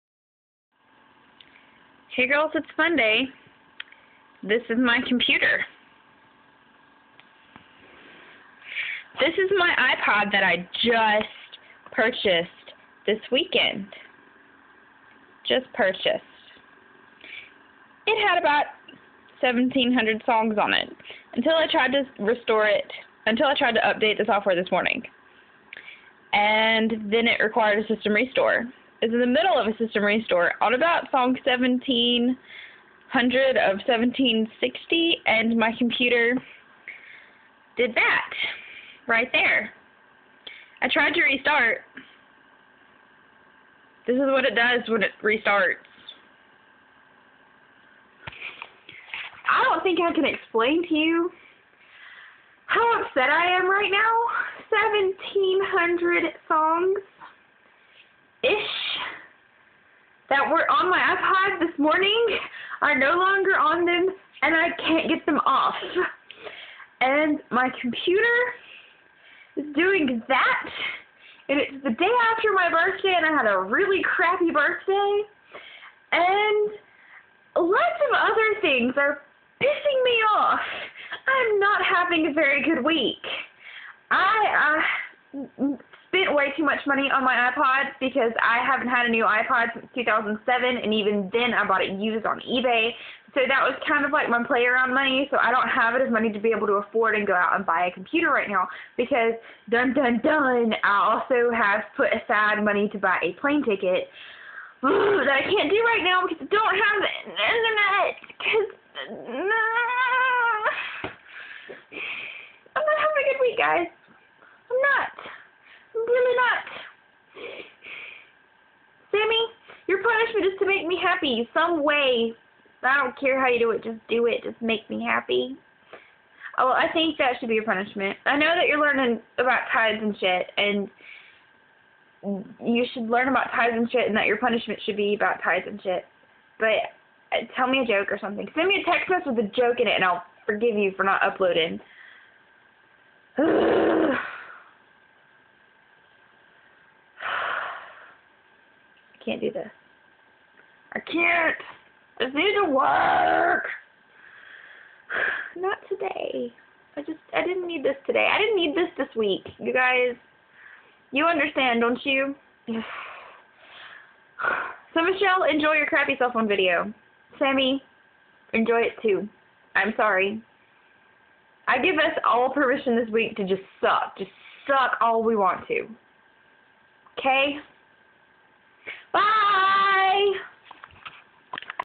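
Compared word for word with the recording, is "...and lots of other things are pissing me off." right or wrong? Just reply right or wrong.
right.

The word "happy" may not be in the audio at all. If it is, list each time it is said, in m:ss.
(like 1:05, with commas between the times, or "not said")
2:01, 2:05.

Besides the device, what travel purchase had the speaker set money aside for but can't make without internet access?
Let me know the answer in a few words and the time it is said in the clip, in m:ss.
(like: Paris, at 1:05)
A plane ticket, at 1:43.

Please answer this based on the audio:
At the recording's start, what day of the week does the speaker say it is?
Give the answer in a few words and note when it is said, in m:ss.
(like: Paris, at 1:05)
Monday, at 0:02.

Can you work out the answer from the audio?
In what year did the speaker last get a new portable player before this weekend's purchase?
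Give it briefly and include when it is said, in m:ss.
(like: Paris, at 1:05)
2007, at 1:29.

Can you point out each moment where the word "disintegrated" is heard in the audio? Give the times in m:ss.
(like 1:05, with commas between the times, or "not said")
not said.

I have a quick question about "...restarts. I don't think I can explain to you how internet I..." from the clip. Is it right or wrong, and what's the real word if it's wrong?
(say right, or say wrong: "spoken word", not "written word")
wrong: "upset", not "internet".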